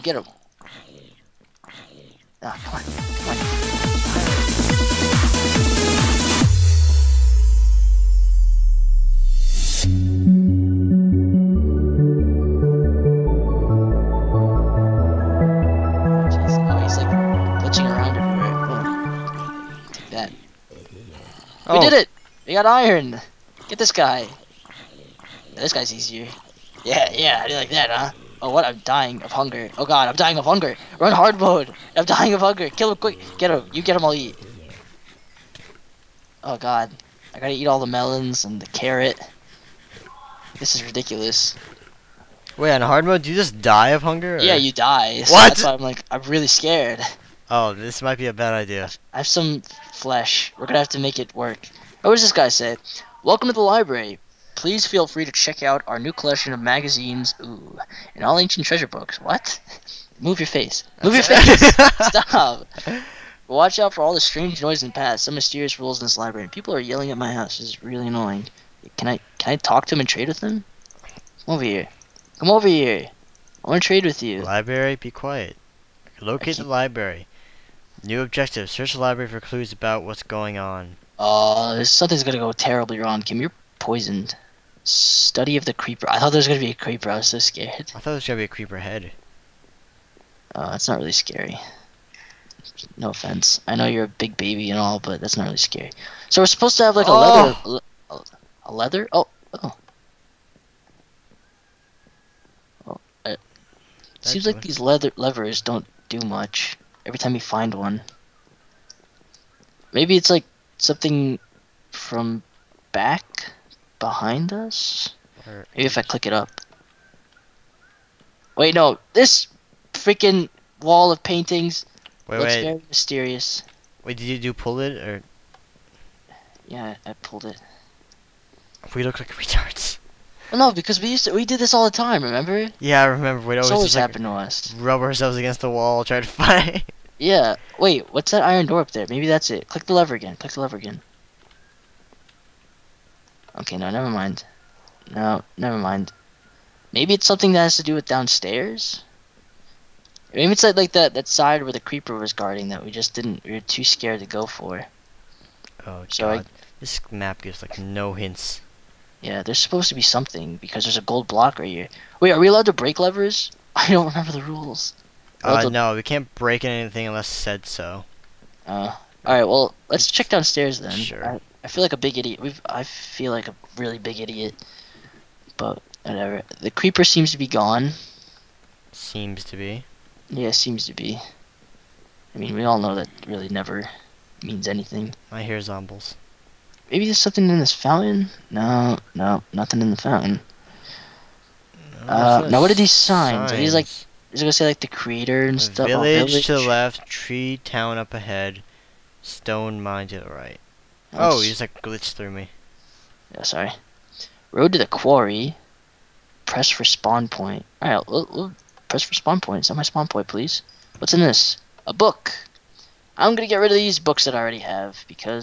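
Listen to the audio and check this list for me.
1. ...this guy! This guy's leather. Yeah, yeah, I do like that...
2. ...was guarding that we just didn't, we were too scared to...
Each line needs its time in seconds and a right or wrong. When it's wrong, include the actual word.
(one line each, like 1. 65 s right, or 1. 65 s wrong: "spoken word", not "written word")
1. 23 s wrong: "easier", not "leather"
2. 152 s right.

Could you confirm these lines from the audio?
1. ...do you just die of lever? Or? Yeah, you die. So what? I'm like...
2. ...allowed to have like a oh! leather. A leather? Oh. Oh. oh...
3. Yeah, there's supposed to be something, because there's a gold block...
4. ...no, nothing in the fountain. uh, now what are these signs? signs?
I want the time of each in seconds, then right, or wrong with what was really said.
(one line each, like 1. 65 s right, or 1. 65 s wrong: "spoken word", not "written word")
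1. 43 s wrong: "hunger", not "lever"
2. 96 s wrong: "supposed", not "allowed"
3. 159 s right
4. 189 s right.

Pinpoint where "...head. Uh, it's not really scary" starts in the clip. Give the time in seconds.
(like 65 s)
88 s.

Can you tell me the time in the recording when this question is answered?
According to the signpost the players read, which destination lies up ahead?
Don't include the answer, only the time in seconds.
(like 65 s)
197 s.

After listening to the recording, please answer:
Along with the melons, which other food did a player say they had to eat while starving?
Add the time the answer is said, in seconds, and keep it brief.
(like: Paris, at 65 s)
Carrot, at 38 s.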